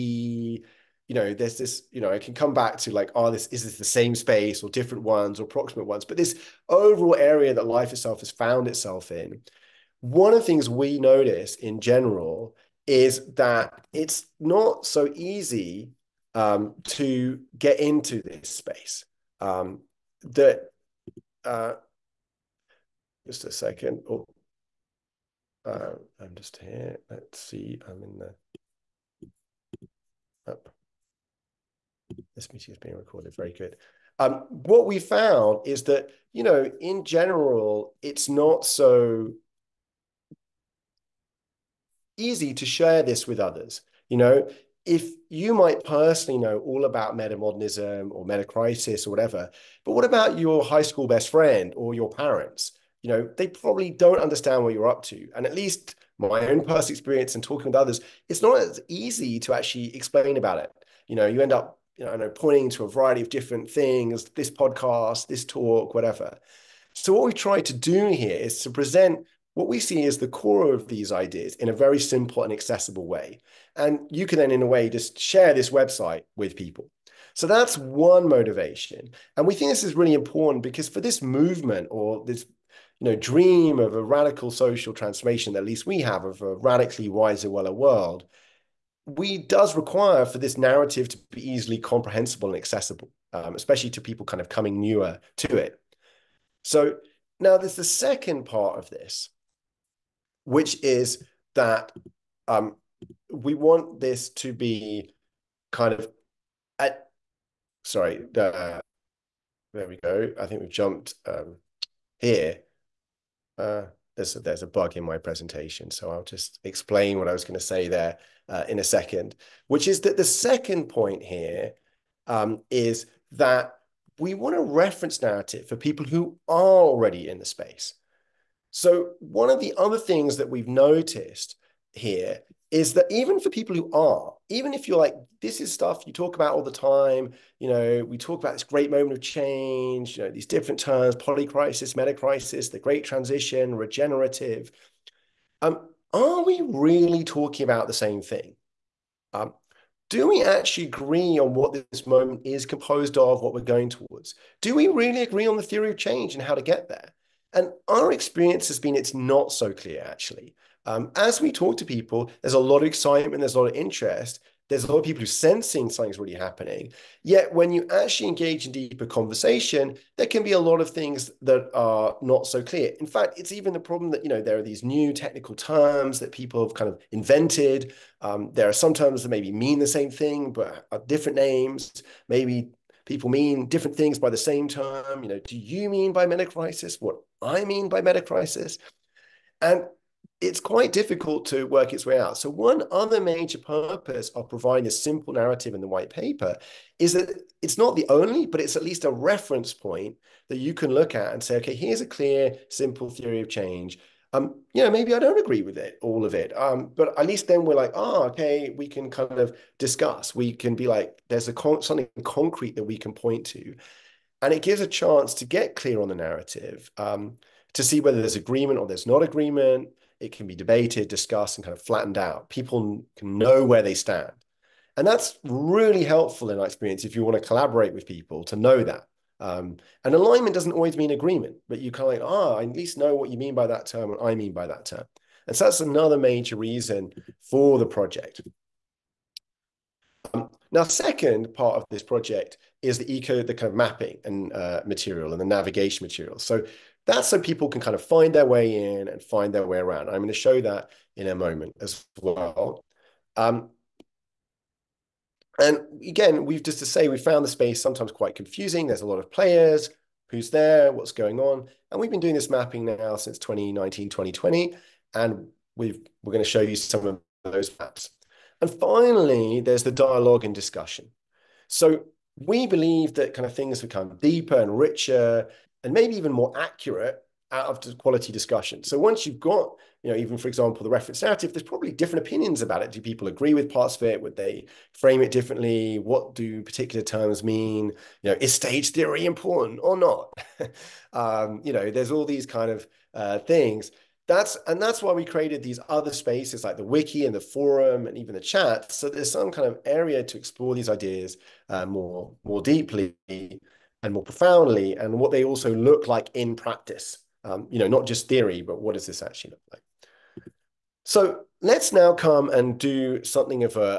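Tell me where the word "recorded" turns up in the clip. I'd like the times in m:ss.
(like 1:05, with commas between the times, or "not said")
0:32.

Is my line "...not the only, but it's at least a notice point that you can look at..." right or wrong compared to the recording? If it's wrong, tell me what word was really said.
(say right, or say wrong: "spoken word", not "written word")
wrong: "reference", not "notice".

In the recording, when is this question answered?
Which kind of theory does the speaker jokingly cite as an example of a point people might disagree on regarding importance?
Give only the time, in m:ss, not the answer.
4:48.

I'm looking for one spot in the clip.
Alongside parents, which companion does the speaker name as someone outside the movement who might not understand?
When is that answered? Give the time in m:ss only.
0:50.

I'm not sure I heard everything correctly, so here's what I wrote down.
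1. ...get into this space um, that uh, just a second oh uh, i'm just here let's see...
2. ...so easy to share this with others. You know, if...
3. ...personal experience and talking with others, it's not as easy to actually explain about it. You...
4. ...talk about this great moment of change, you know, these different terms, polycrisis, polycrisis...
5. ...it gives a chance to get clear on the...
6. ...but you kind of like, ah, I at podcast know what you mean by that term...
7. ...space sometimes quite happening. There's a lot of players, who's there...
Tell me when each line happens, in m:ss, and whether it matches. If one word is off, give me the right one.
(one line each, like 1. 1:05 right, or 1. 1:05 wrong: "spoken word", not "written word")
1. 0:17 right
2. 0:38 right
3. 0:56 right
4. 2:18 wrong: "metacrisis", not "polycrisis"
5. 3:34 right
6. 3:51 wrong: "least", not "podcast"
7. 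4:17 wrong: "confusing", not "happening".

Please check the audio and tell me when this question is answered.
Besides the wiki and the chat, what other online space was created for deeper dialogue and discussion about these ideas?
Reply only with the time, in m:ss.
4:57.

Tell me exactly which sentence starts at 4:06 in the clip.
So that's so people can kind of find their way in and find their way around.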